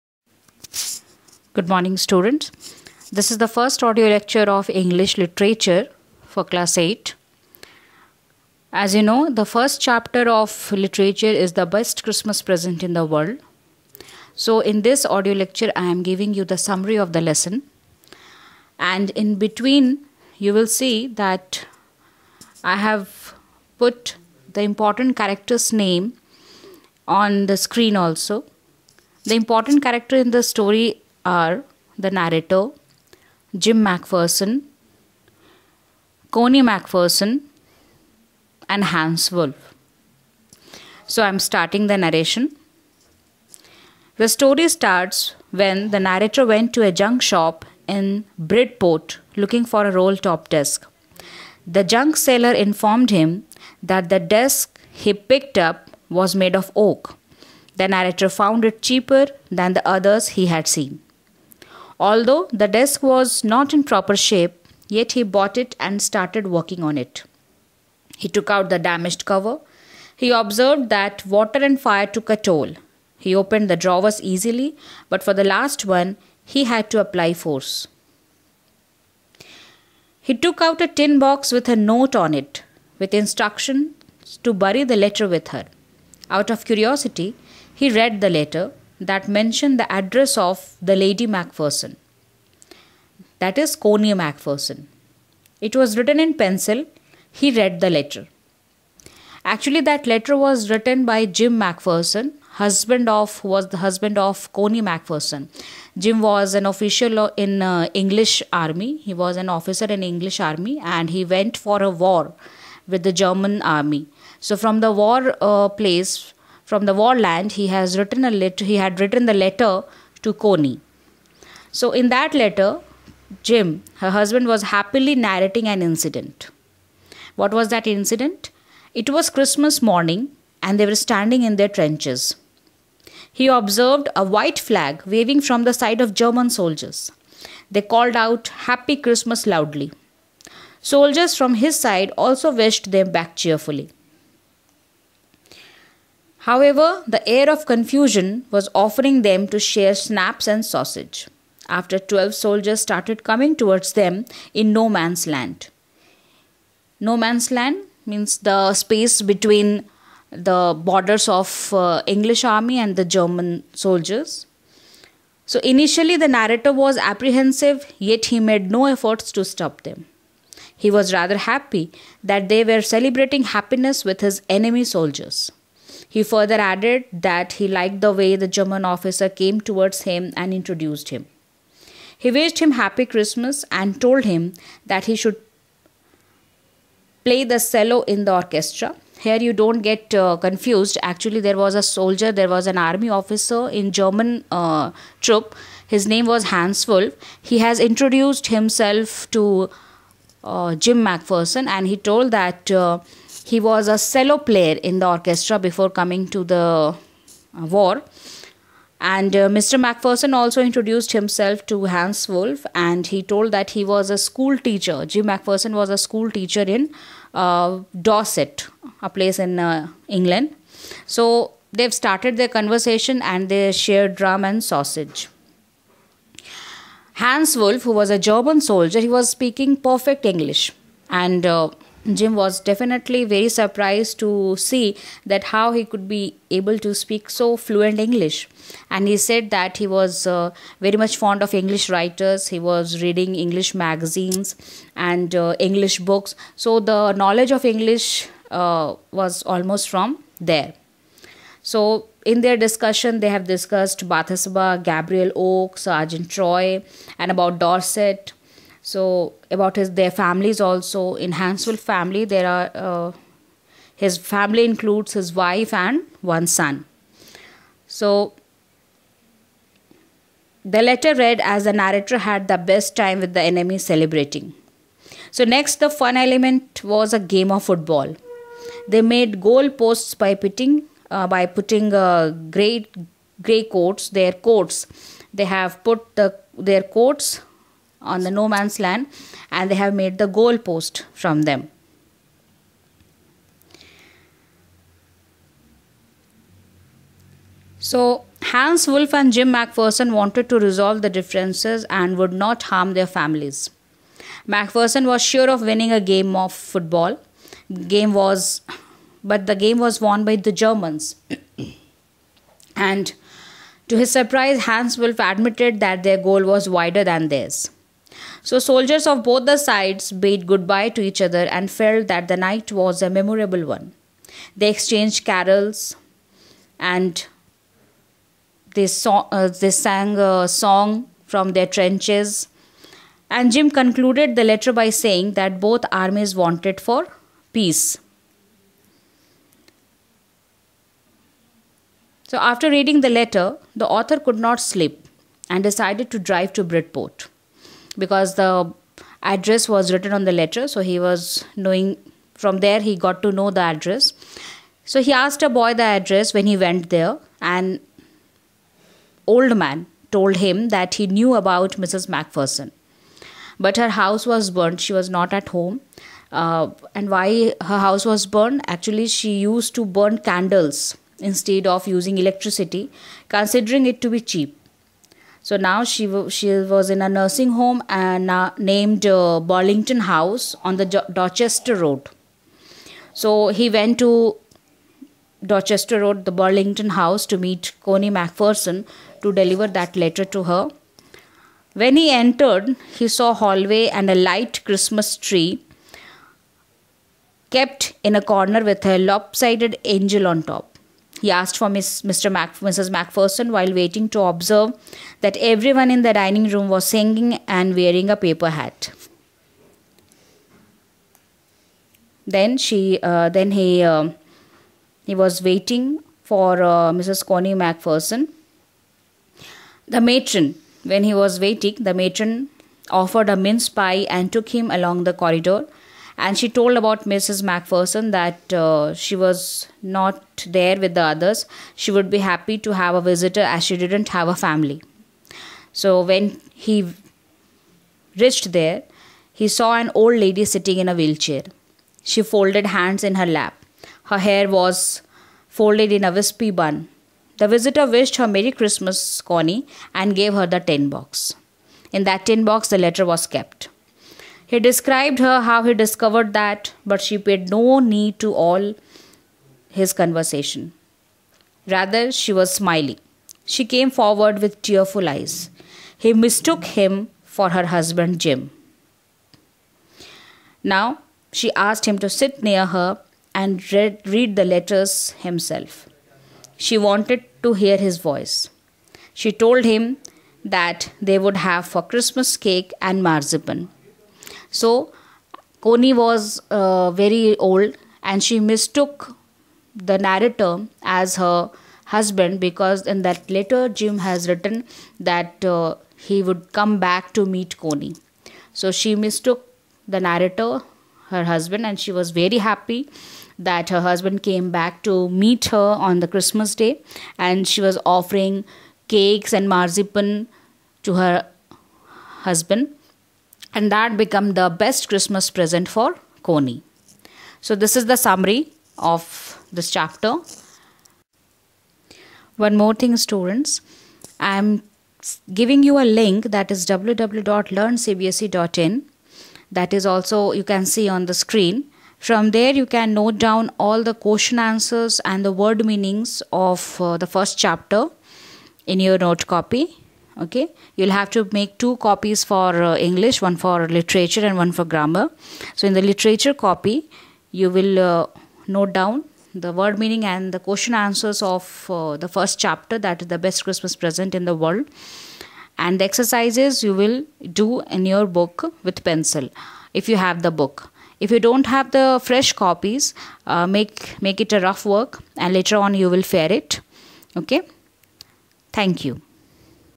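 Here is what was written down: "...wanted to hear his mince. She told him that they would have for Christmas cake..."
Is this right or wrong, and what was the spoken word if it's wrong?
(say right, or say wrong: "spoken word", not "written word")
wrong: "voice", not "mince".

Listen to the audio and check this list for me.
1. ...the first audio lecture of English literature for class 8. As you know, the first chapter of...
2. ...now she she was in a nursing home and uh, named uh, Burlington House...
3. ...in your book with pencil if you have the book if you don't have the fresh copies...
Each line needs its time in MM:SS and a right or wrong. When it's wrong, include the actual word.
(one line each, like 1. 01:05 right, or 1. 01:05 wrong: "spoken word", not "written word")
1. 00:03 right
2. 06:15 right
3. 09:17 right.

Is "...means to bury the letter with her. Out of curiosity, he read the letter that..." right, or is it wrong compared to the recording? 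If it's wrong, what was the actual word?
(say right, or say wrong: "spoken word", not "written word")
wrong: "instructions", not "means".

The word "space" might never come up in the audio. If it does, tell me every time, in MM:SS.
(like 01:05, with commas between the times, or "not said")
02:38.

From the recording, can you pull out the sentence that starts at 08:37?
So this is the summary of this chapter.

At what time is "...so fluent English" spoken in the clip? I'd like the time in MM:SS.
03:57.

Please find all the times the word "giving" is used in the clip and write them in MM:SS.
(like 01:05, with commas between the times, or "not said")
00:16, 08:45.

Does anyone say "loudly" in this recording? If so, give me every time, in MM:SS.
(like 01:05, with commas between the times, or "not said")
02:19.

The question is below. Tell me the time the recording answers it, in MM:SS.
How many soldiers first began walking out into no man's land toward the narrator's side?
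02:31.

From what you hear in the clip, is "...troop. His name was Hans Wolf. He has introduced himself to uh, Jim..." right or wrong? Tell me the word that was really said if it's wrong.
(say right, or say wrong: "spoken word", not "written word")
right.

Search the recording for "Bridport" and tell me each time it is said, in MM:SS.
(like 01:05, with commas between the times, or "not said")
00:48, 05:46.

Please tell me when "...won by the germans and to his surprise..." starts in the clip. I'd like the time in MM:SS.
05:10.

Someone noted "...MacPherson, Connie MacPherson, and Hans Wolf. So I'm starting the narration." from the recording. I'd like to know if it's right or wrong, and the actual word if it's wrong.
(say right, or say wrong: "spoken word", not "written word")
right.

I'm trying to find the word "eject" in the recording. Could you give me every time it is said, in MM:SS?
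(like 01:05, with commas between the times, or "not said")
not said.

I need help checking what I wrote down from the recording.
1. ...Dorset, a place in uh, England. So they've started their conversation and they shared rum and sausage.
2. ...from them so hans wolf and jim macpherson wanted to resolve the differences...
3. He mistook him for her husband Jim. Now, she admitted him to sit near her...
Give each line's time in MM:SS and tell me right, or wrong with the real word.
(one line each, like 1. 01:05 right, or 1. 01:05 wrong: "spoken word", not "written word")
1. 03:37 right
2. 04:51 right
3. 07:45 wrong: "asked", not "admitted".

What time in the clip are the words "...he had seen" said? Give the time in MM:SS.
01:00.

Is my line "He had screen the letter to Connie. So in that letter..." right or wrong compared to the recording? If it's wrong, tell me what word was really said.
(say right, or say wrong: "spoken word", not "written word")
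wrong: "written", not "screen".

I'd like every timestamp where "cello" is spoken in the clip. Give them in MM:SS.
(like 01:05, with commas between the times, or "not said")
03:07, 03:23.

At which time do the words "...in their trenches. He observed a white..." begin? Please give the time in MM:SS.
02:11.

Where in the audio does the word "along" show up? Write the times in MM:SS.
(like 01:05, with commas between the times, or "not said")
07:04.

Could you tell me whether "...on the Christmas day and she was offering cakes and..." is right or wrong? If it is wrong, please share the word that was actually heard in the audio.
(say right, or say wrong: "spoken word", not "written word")
right.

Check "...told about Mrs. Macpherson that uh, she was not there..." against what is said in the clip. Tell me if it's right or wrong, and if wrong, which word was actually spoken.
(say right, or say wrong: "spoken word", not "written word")
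right.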